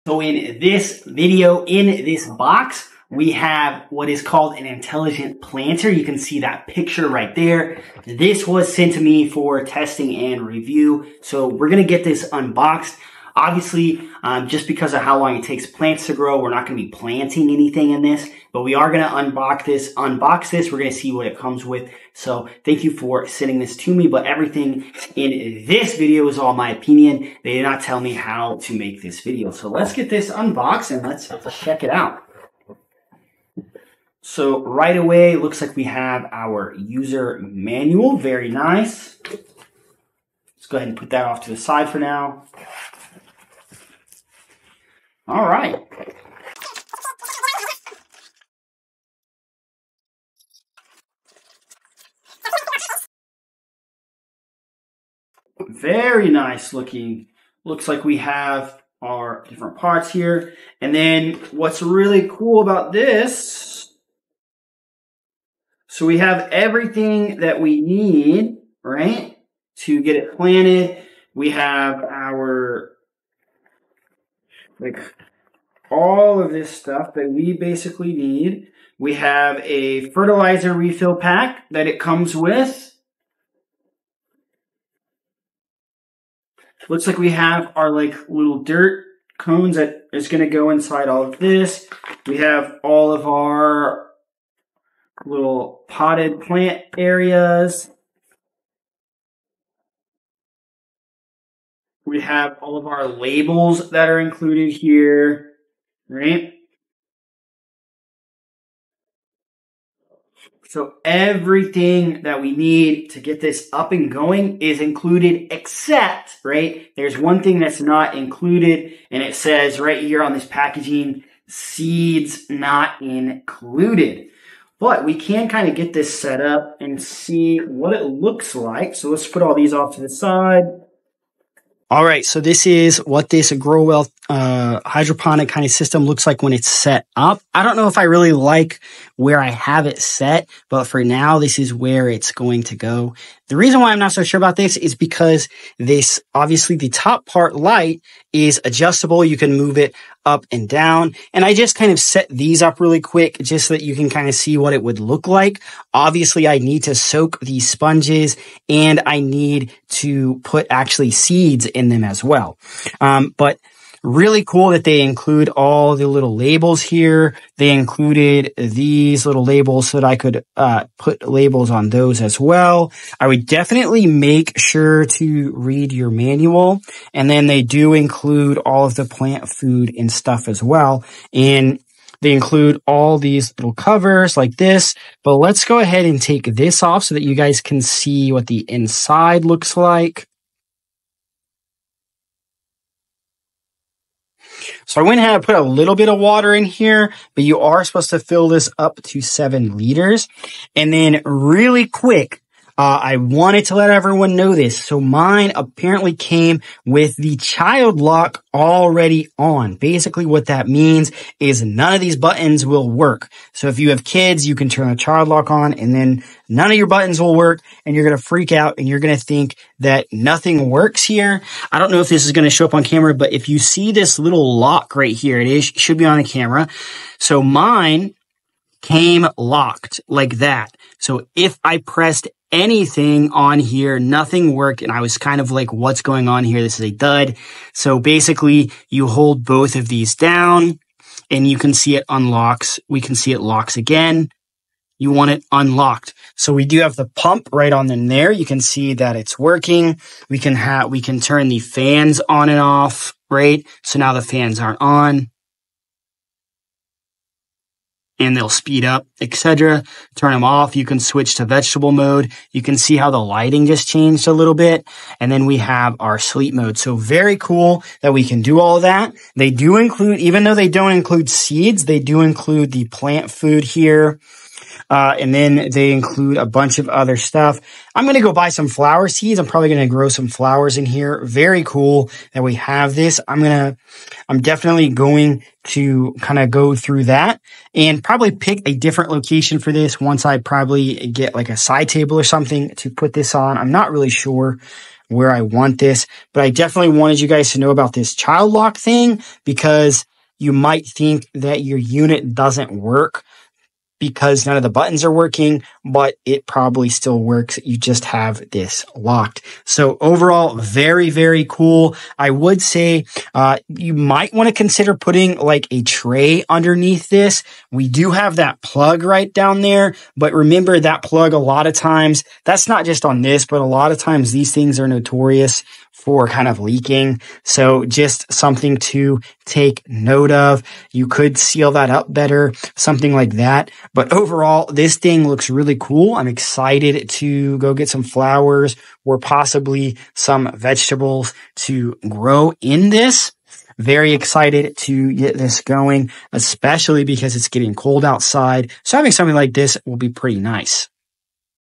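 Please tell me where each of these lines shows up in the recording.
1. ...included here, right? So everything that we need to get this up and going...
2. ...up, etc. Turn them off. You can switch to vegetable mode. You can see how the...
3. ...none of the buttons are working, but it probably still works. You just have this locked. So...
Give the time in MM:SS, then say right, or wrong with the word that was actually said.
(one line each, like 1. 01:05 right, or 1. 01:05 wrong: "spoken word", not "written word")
1. 01:44 right
2. 04:18 right
3. 05:04 right.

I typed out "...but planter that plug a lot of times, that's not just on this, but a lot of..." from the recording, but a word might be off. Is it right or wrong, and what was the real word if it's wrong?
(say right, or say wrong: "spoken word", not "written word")
wrong: "remember", not "planter".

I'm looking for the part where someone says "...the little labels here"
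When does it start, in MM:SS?
02:45.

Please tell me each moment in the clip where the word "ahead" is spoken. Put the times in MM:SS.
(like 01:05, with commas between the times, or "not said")
00:40, 03:05, 03:15.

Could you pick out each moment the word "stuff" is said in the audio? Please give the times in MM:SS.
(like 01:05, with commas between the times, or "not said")
01:16, 03:00, 04:37.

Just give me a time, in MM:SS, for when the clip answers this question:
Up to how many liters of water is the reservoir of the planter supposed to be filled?
03:19.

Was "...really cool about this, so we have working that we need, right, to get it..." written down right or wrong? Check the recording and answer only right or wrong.
wrong.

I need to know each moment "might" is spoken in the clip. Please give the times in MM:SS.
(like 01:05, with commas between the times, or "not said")
05:00, 05:13.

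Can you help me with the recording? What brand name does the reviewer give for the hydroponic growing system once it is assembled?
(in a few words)
Growell.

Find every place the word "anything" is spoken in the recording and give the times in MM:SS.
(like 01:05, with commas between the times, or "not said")
00:17, 03:52.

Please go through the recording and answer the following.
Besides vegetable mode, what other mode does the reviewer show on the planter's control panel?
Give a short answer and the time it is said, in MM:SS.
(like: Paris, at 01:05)
Sleep mode, at 04:26.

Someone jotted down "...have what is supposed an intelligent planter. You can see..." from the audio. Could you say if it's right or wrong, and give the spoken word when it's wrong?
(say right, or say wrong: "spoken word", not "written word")
wrong: "called", not "supposed".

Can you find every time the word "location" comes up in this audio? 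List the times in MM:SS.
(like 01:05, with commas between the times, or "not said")
04:49.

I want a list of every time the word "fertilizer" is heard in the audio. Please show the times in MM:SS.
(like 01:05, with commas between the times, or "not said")
01:20.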